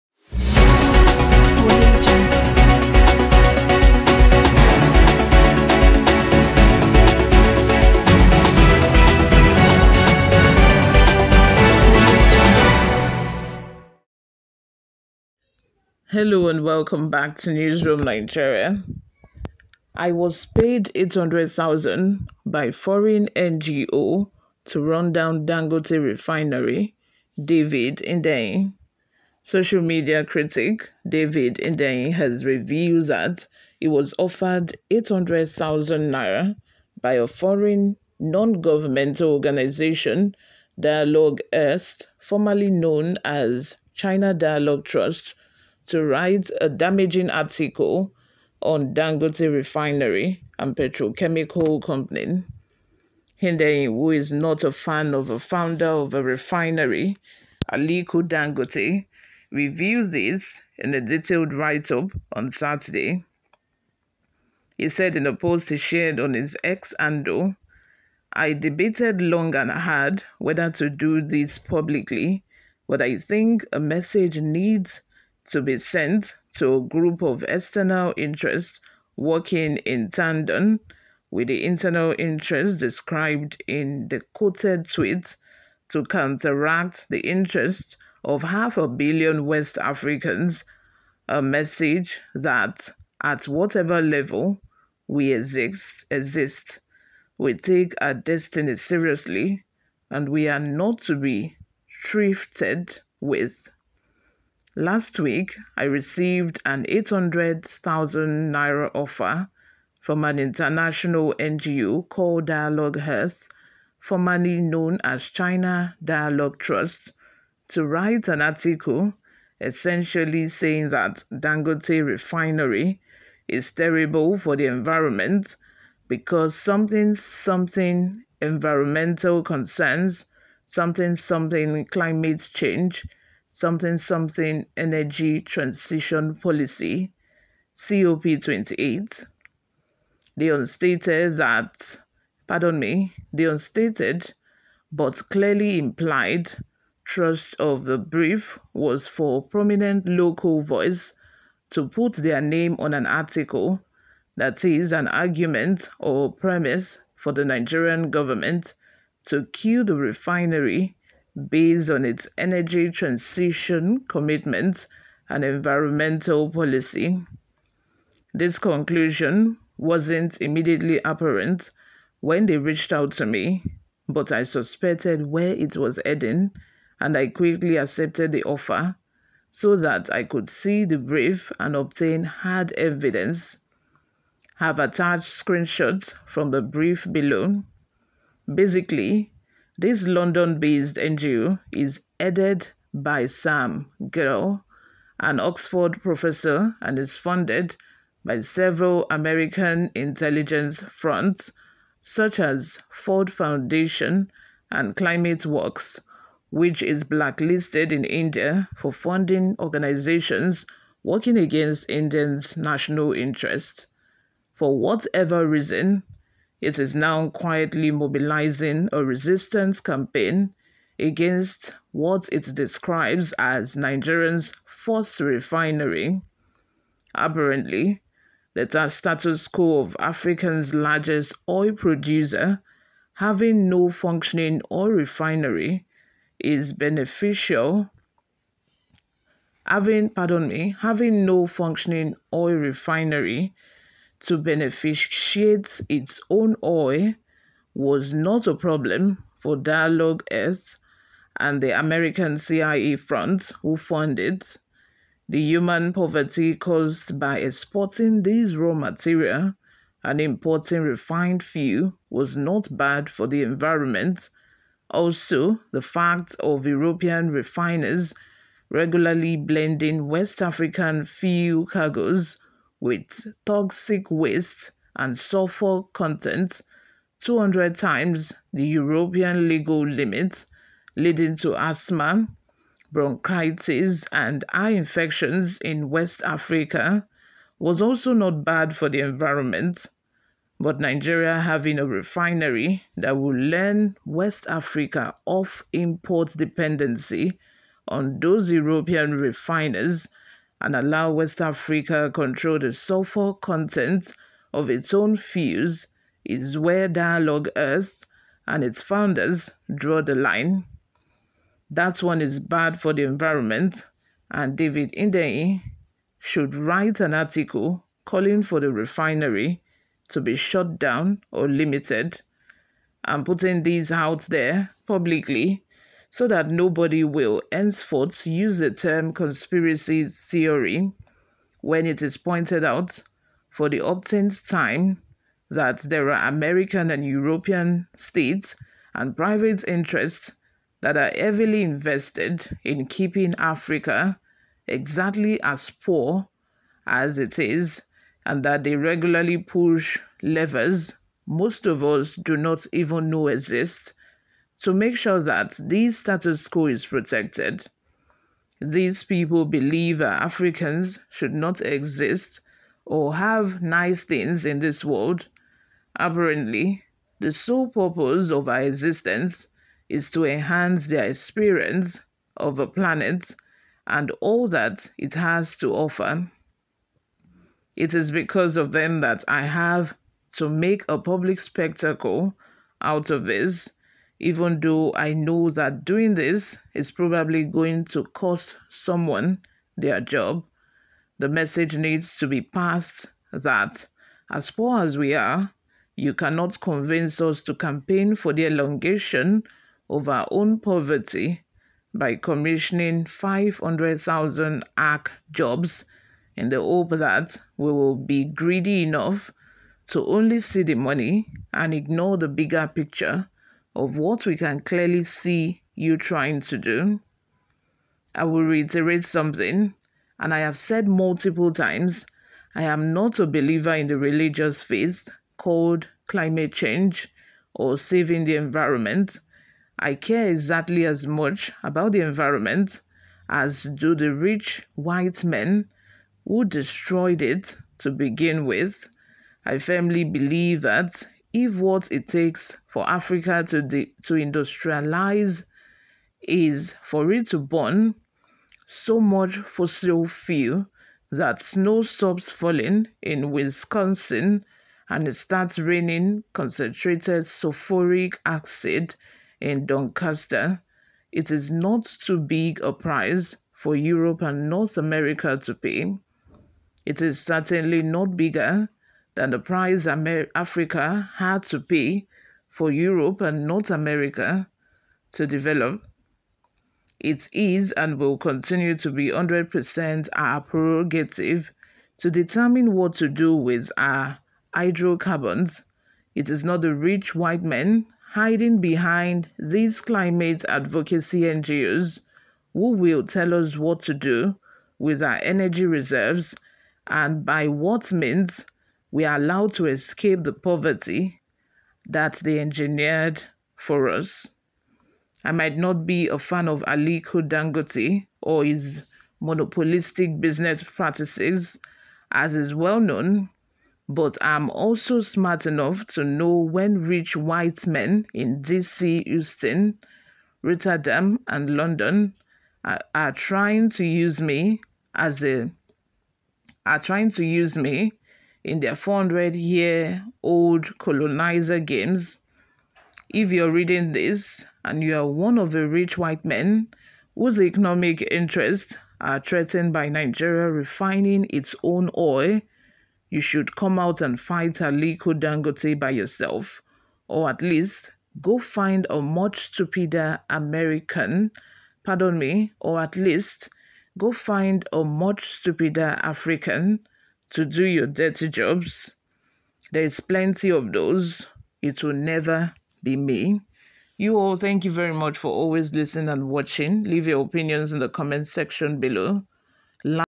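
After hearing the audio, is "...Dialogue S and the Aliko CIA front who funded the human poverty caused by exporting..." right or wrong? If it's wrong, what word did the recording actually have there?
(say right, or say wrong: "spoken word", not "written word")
wrong: "American", not "Aliko".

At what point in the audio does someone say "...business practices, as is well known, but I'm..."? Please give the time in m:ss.
8:30.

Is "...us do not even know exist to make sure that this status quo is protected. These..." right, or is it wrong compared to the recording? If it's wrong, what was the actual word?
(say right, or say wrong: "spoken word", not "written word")
right.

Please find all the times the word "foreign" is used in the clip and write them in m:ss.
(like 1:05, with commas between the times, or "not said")
0:22, 0:37.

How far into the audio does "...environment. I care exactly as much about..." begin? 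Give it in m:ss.
7:08.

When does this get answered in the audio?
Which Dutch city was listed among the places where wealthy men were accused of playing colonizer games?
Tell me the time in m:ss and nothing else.
8:40.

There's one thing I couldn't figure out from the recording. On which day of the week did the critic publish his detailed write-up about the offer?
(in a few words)
Saturday.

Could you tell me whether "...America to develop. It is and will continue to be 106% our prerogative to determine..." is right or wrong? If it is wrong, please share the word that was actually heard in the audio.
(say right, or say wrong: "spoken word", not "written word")
wrong: "100", not "106".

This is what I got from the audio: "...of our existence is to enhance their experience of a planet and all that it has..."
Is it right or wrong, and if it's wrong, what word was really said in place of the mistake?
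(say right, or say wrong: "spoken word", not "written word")
right.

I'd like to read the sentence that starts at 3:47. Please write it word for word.
Apparently, the status quo of Africa's largest oil producer having no functioning oil refinery is beneficial.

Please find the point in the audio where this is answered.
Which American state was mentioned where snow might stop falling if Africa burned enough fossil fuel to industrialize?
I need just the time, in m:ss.
7:33.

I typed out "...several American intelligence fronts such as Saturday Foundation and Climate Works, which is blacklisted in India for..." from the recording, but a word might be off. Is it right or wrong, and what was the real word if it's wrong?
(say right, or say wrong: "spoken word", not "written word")
wrong: "Ford", not "Saturday".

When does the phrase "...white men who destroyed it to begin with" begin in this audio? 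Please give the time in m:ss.
7:14.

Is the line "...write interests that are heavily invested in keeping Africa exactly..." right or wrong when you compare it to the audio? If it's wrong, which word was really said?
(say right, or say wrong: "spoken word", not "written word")
wrong: "private", not "write".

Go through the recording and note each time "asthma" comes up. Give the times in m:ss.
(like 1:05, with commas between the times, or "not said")
4:41.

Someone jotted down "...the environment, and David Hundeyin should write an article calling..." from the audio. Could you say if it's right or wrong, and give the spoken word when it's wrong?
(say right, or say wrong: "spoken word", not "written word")
right.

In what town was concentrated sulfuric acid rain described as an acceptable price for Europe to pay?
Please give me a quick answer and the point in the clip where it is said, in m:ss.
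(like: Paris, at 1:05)
Doncaster, at 7:39.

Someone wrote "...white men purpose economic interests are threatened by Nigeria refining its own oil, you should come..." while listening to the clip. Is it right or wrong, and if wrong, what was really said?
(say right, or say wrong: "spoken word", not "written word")
wrong: "whose", not "purpose".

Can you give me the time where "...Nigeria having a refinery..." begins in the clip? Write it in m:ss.
4:50.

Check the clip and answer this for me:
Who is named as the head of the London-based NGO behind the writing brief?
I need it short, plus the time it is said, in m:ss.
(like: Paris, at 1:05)
Sam Geall, at 3:13.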